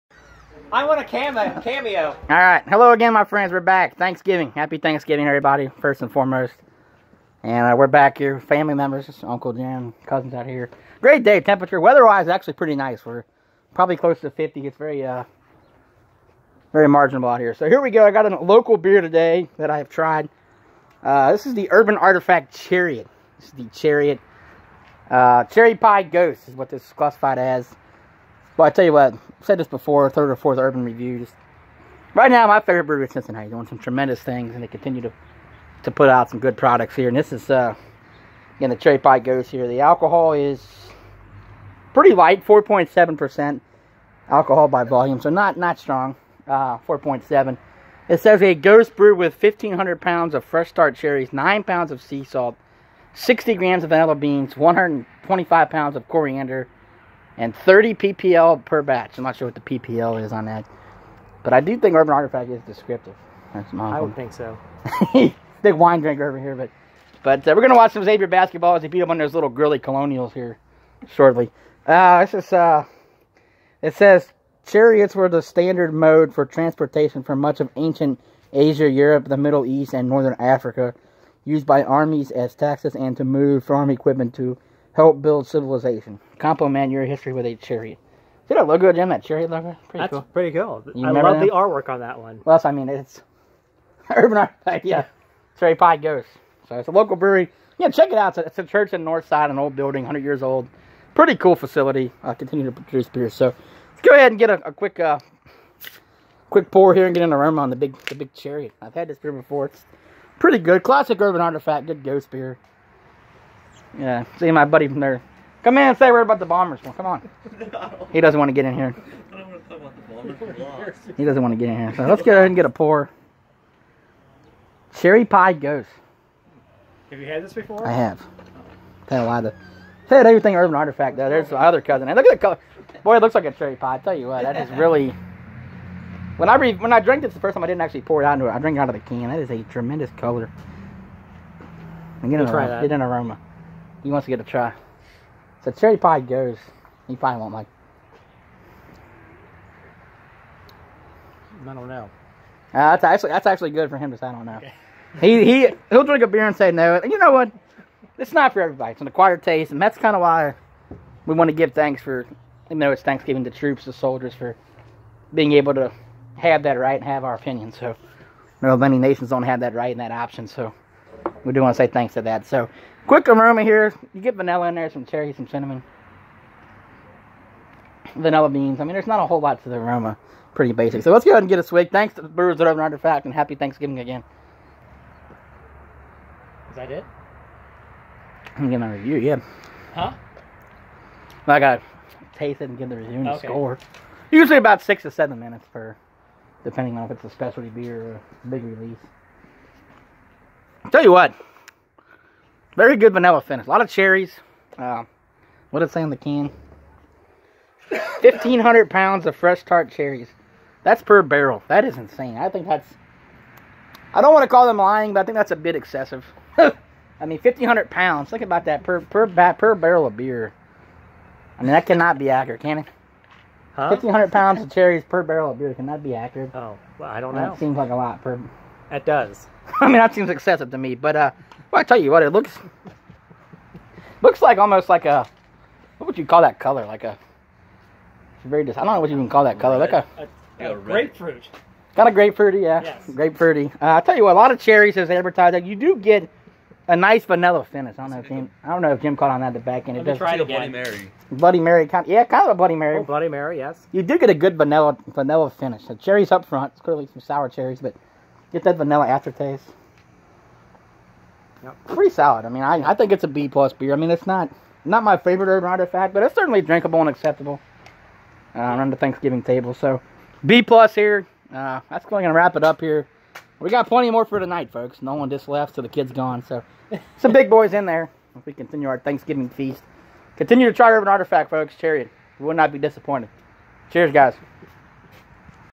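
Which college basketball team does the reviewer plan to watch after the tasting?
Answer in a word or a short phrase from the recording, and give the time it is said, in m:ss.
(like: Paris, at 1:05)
Xavier, at 1:08.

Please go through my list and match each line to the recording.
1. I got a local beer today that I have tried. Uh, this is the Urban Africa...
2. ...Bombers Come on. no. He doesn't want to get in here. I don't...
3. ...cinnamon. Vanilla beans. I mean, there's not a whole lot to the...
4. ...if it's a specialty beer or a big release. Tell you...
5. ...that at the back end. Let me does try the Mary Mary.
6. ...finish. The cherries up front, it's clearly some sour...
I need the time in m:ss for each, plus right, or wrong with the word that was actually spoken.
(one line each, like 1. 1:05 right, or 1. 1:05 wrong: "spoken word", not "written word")
1. 0:18 wrong: "Artifact", not "Africa"
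2. 1:56 right
3. 2:55 right
4. 3:17 right
5. 4:09 wrong: "Bloody", not "Mary"
6. 4:15 right.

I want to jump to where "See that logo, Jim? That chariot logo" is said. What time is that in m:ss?
1:28.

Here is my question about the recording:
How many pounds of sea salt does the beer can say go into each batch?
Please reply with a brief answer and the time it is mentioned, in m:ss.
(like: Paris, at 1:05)
9 pounds, at 0:51.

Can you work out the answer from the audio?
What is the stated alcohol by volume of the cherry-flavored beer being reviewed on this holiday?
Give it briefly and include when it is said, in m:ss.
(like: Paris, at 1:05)
4.7%, at 0:42.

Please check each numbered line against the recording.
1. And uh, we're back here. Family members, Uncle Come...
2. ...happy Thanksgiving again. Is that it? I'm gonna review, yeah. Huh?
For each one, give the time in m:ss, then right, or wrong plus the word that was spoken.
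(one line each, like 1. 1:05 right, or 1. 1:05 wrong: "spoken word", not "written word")
1. 0:07 wrong: "Jim", not "Come"
2. 3:03 right.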